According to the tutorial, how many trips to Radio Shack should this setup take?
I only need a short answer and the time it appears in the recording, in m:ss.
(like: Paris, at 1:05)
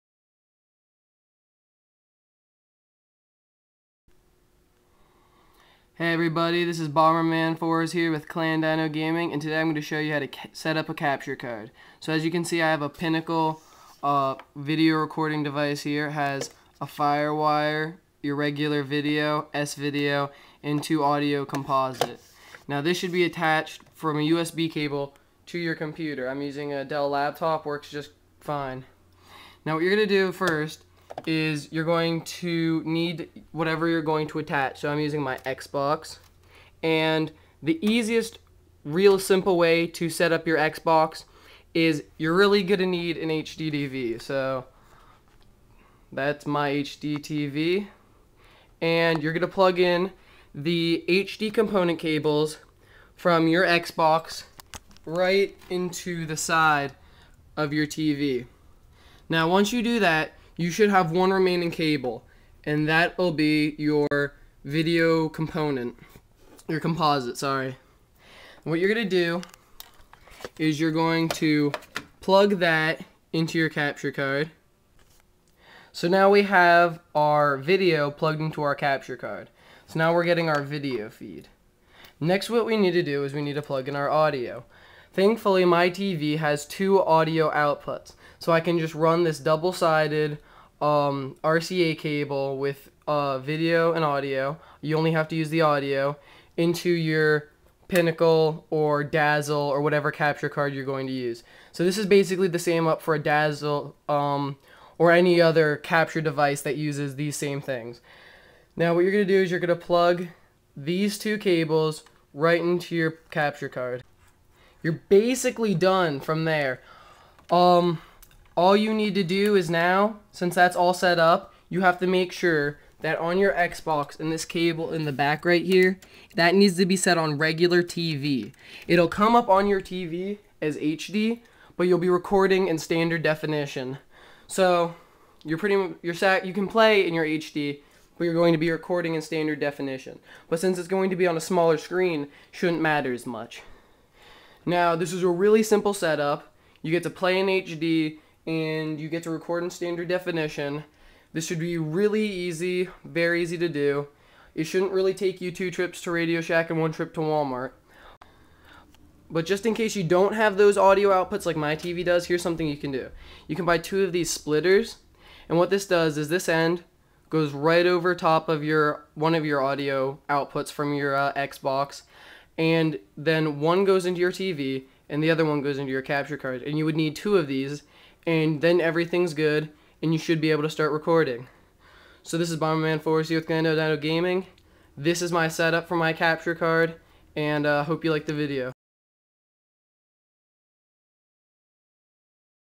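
2, at 2:35.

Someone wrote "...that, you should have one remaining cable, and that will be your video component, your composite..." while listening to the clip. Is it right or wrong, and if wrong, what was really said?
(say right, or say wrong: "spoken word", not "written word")
right.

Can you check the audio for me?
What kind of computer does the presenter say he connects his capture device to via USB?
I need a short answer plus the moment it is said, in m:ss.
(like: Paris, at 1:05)
Dell laptop, at 0:26.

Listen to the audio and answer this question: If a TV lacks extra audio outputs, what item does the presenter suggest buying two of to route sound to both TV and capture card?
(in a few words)
Splitters.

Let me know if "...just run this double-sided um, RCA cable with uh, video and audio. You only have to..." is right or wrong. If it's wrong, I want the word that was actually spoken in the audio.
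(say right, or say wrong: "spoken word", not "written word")
right.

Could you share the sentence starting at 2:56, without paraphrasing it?
And you would need two of these and then everything's good, and you should be able to start recording.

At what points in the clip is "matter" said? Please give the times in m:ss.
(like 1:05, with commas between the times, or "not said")
2:22.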